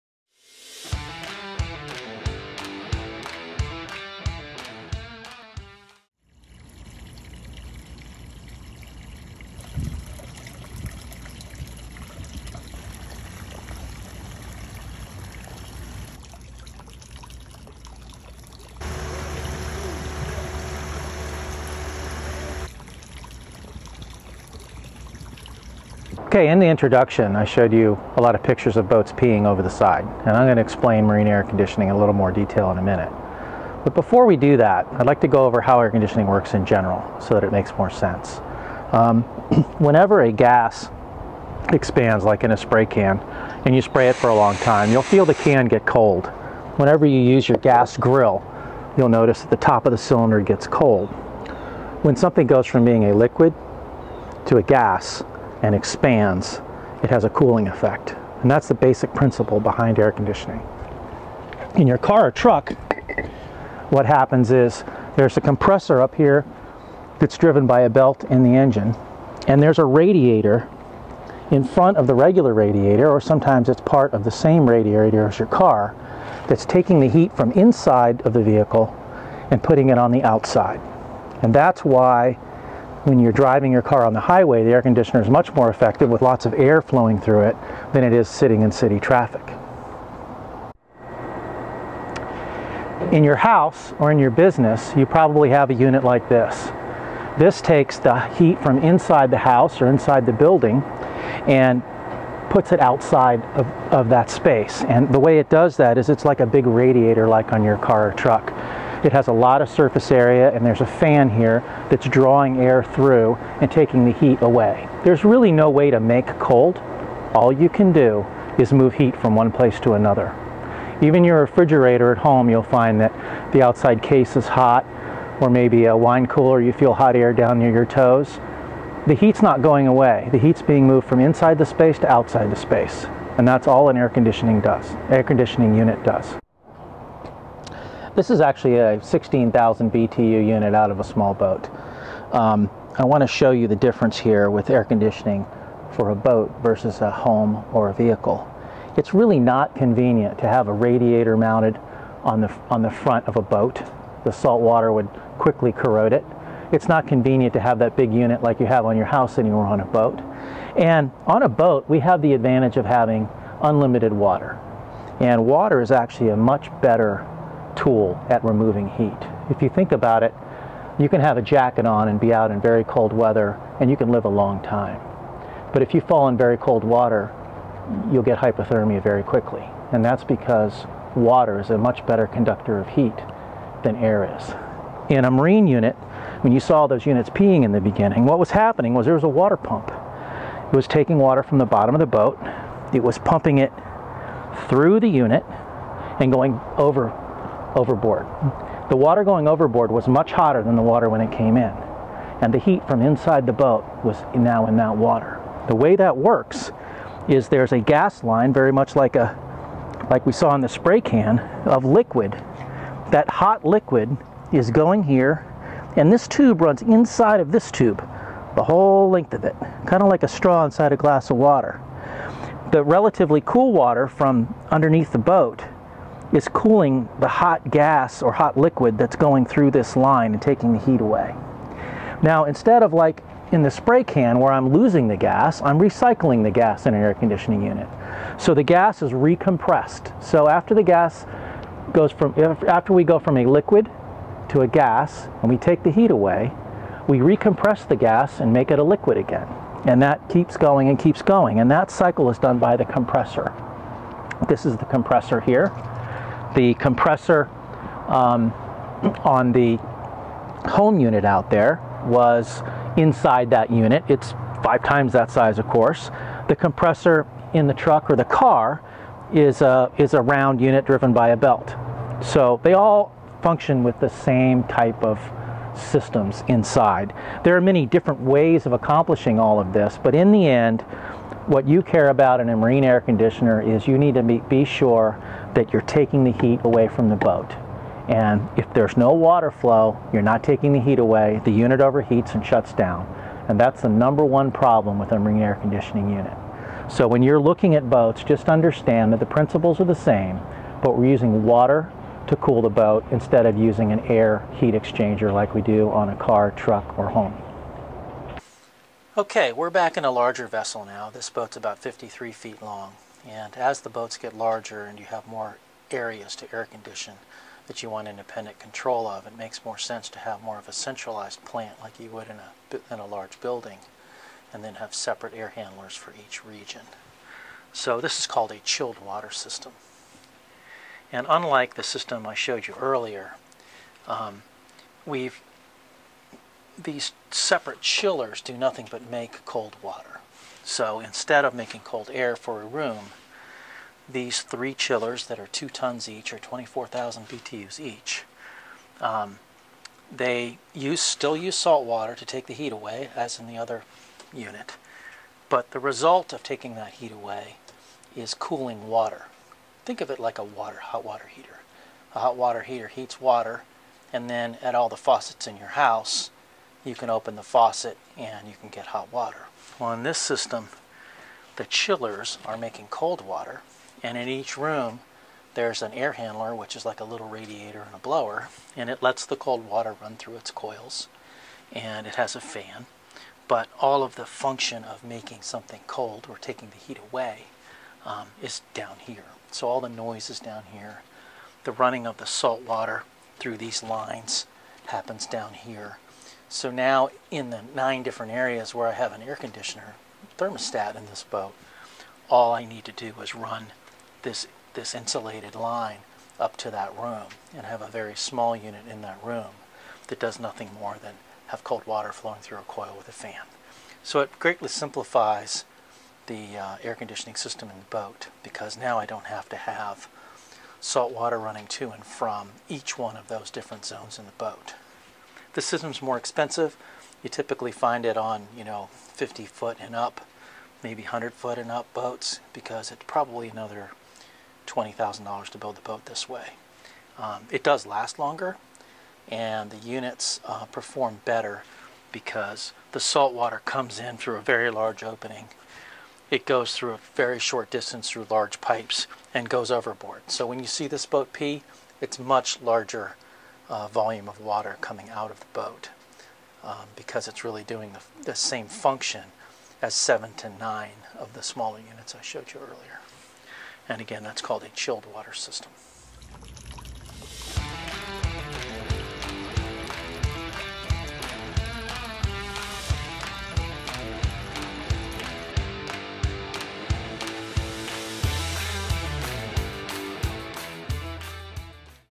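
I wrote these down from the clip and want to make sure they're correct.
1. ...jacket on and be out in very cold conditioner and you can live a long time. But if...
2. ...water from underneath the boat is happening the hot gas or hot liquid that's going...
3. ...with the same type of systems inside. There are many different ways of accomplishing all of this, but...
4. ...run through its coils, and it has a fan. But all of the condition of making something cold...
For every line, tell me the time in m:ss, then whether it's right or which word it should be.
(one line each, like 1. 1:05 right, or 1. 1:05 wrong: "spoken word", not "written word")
1. 2:51 wrong: "weather", not "conditioner"
2. 3:43 wrong: "cooling", not "happening"
3. 4:33 right
4. 6:20 wrong: "function", not "condition".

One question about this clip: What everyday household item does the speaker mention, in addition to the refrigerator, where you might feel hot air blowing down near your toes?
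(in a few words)
wine cooler.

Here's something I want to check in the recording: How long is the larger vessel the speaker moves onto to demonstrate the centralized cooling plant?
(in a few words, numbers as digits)
53 feet.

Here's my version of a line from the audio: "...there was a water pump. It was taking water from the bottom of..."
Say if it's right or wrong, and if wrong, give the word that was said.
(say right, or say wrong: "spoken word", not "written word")
right.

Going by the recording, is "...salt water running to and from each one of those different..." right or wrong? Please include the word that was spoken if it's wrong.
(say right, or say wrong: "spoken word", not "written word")
right.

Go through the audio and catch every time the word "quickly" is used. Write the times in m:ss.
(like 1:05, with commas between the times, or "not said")
2:35, 2:59.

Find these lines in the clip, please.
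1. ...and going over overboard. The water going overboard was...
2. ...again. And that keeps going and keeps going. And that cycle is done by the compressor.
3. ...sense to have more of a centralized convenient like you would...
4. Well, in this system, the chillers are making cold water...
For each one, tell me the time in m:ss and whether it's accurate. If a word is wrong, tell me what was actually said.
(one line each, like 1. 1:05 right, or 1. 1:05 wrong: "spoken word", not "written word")
1. 3:16 right
2. 4:09 right
3. 5:19 wrong: "plant", not "convenient"
4. 6:09 right.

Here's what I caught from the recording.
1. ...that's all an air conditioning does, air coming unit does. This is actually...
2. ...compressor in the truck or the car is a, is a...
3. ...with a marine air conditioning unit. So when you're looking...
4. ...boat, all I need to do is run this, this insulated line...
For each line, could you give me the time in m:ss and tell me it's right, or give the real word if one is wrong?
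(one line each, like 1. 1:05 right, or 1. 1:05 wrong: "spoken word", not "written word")
1. 2:13 wrong: "conditioning", not "coming"
2. 4:26 right
3. 4:54 right
4. 6:41 right.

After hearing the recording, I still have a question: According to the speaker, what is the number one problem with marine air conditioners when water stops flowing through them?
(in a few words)
the unit overheats.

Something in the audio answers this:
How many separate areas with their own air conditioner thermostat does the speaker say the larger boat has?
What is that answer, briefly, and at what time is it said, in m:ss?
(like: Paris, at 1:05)
9, at 6:37.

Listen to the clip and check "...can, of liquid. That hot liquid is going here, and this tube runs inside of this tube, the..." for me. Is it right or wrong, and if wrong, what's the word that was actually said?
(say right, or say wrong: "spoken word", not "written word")
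right.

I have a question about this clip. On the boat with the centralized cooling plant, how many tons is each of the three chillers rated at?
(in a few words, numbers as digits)
2 tons.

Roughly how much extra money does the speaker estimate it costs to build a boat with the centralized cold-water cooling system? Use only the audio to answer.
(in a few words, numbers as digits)
$20,000.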